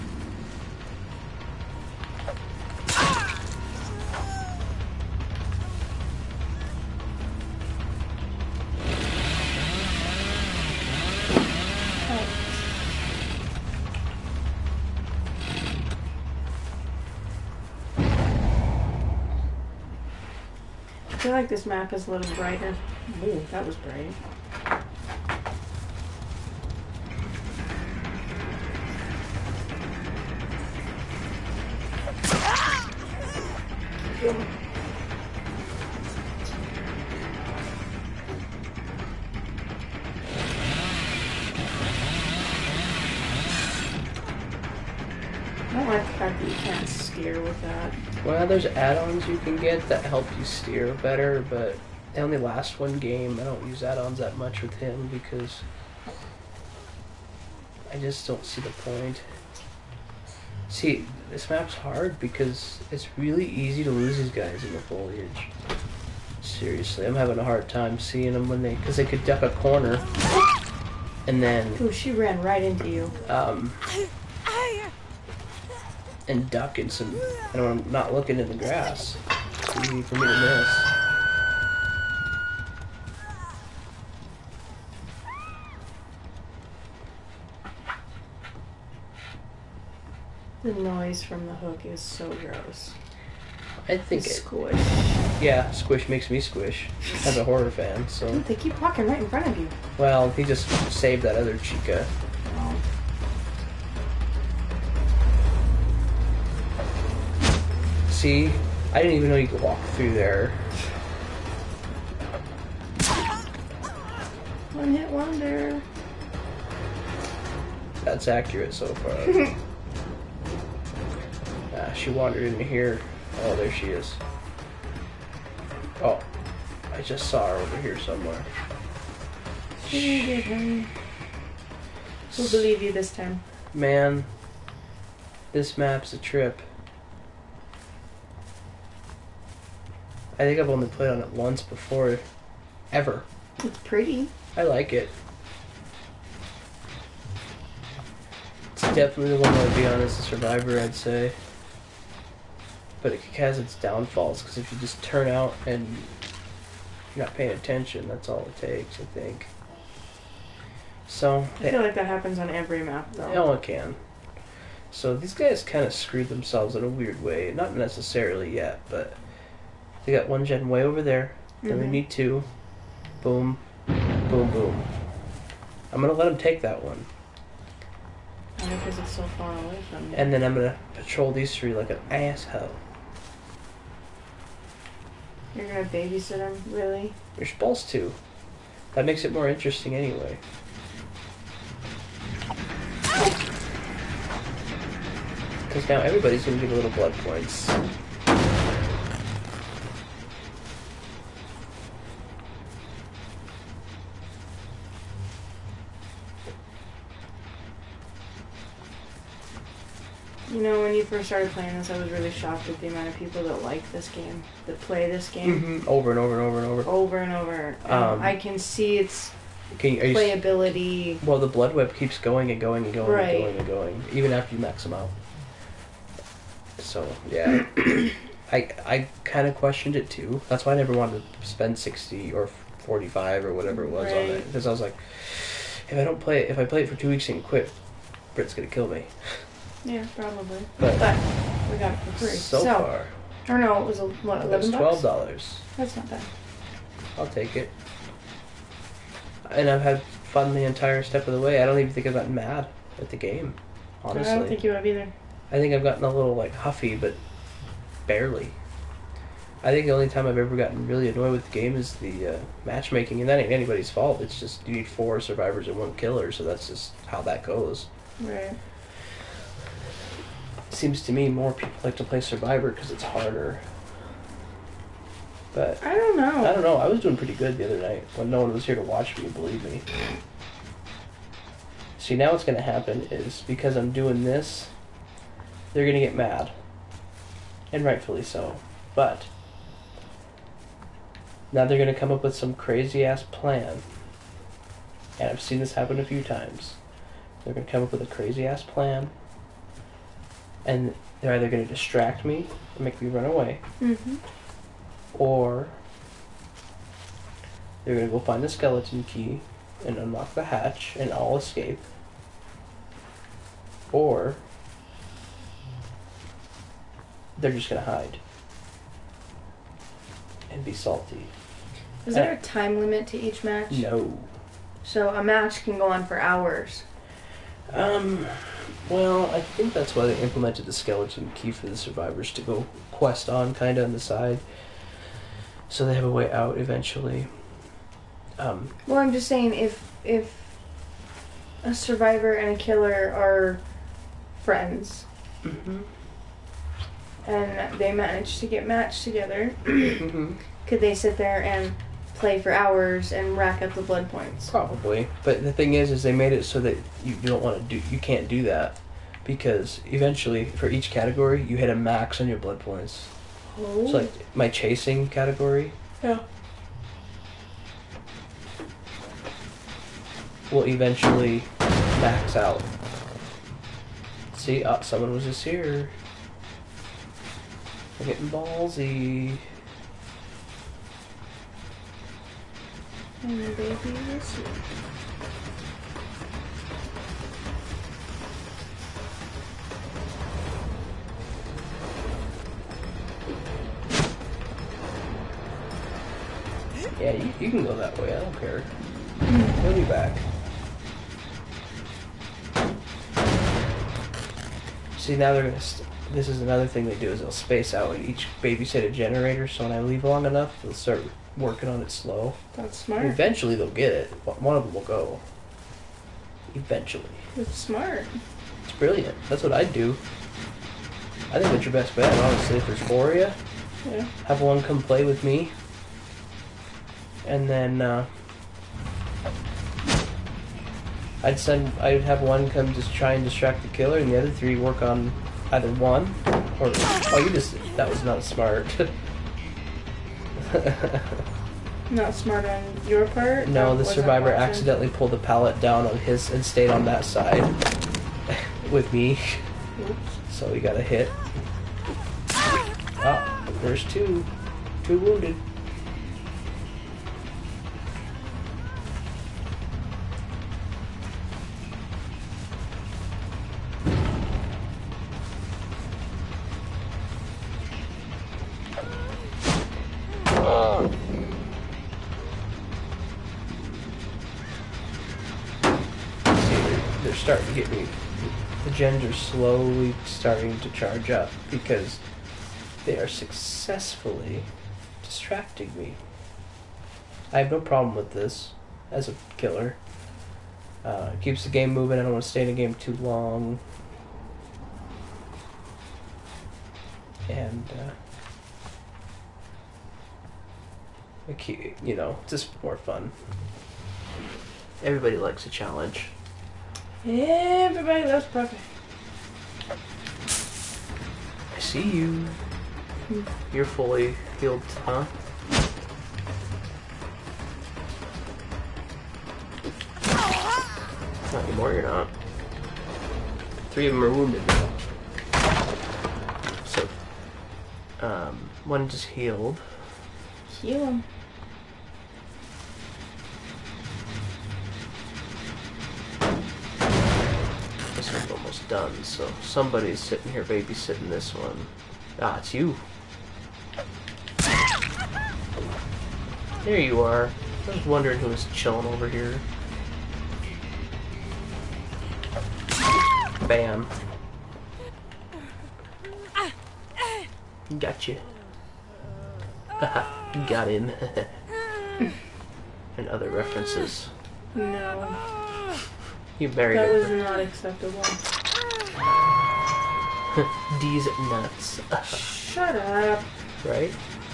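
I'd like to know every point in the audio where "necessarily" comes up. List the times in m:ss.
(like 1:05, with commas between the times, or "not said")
2:47.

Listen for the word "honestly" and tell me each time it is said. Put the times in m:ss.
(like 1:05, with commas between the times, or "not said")
4:14, 7:02.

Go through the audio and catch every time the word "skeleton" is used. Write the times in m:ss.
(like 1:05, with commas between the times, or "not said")
5:08, 5:30.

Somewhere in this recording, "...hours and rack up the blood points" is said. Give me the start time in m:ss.
5:52.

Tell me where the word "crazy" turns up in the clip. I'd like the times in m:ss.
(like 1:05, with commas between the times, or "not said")
4:52, 4:58.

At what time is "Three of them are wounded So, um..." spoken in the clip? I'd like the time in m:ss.
8:43.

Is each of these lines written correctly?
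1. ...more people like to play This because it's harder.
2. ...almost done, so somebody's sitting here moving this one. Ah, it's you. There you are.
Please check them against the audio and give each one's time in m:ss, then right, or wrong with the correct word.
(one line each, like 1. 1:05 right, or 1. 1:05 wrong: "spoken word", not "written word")
1. 4:31 wrong: "Survivor", not "This"
2. 8:58 wrong: "babysitting", not "moving".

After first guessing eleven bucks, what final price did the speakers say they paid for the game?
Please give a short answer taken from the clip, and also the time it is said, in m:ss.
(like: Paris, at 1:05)
$12, at 4:04.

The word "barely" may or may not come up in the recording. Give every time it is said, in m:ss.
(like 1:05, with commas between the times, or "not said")
4:18.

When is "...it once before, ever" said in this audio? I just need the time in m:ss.
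2:21.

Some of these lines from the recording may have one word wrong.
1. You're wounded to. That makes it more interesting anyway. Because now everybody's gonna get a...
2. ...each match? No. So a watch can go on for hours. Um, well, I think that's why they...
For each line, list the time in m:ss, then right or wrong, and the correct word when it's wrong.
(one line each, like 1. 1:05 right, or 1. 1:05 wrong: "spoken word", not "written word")
1. 3:07 wrong: "supposed", not "wounded"
2. 5:23 wrong: "match", not "watch".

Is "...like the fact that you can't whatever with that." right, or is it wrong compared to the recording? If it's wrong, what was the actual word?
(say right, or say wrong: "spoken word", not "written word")
wrong: "steer", not "whatever".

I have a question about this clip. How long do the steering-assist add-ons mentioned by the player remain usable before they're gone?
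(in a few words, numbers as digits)
One game.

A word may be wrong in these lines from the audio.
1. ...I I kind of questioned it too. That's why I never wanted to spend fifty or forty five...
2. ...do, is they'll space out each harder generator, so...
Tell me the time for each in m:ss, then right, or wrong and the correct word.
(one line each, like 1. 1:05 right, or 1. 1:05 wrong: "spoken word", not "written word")
1. 3:48 wrong: "sixty", not "fifty"
2. 6:46 wrong: "babysitter", not "harder".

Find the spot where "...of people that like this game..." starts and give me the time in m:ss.
3:33.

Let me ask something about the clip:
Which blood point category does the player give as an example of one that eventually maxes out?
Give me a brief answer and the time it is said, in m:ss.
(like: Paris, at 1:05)
Chasing, at 6:04.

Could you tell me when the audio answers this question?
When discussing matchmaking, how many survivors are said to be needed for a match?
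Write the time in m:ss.
4:24.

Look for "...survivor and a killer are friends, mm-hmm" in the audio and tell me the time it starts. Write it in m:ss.
5:41.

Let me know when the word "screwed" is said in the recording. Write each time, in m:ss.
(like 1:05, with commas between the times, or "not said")
2:45.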